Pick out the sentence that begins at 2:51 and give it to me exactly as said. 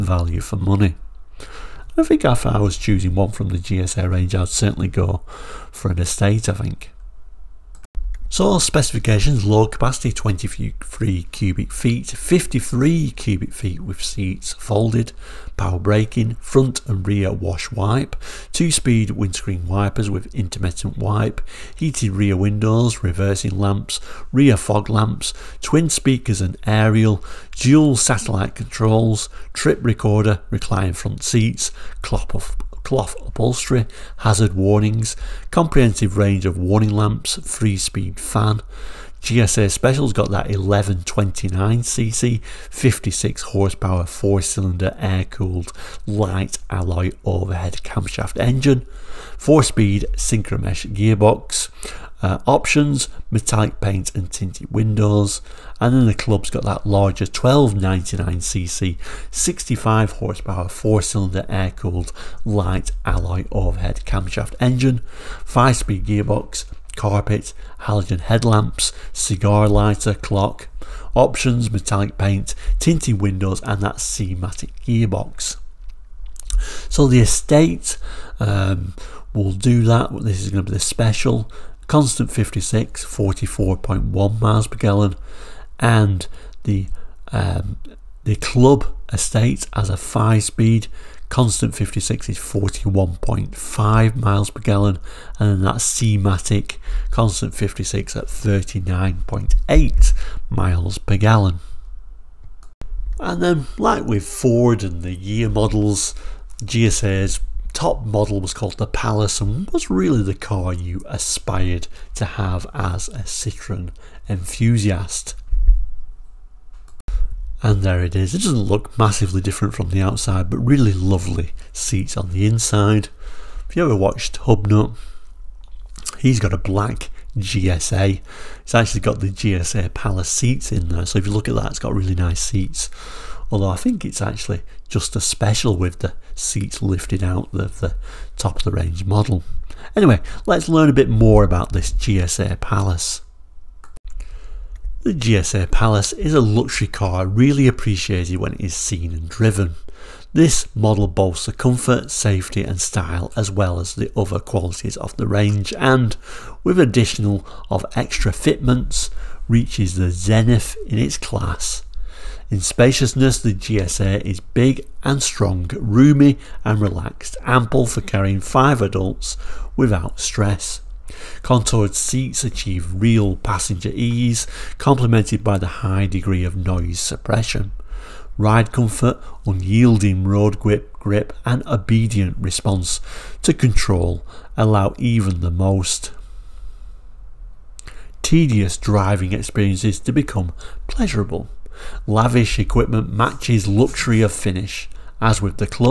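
Contoured seats achieve real passenger ease, complemented by the high degree of noise suppression.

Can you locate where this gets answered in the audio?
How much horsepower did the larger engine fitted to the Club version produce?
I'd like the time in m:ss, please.
0:59.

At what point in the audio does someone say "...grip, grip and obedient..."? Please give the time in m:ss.
3:00.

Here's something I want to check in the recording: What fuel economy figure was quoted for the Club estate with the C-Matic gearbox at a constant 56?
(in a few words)
39.8 miles per gallon.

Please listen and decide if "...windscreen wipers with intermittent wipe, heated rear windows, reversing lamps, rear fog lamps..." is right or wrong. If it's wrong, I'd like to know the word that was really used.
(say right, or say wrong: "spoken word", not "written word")
right.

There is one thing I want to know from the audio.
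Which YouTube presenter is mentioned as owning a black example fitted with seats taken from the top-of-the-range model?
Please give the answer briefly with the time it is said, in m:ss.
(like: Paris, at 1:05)
Hubnut, at 2:04.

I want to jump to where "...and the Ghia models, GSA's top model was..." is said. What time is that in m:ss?
1:44.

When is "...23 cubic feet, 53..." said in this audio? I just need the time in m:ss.
0:10.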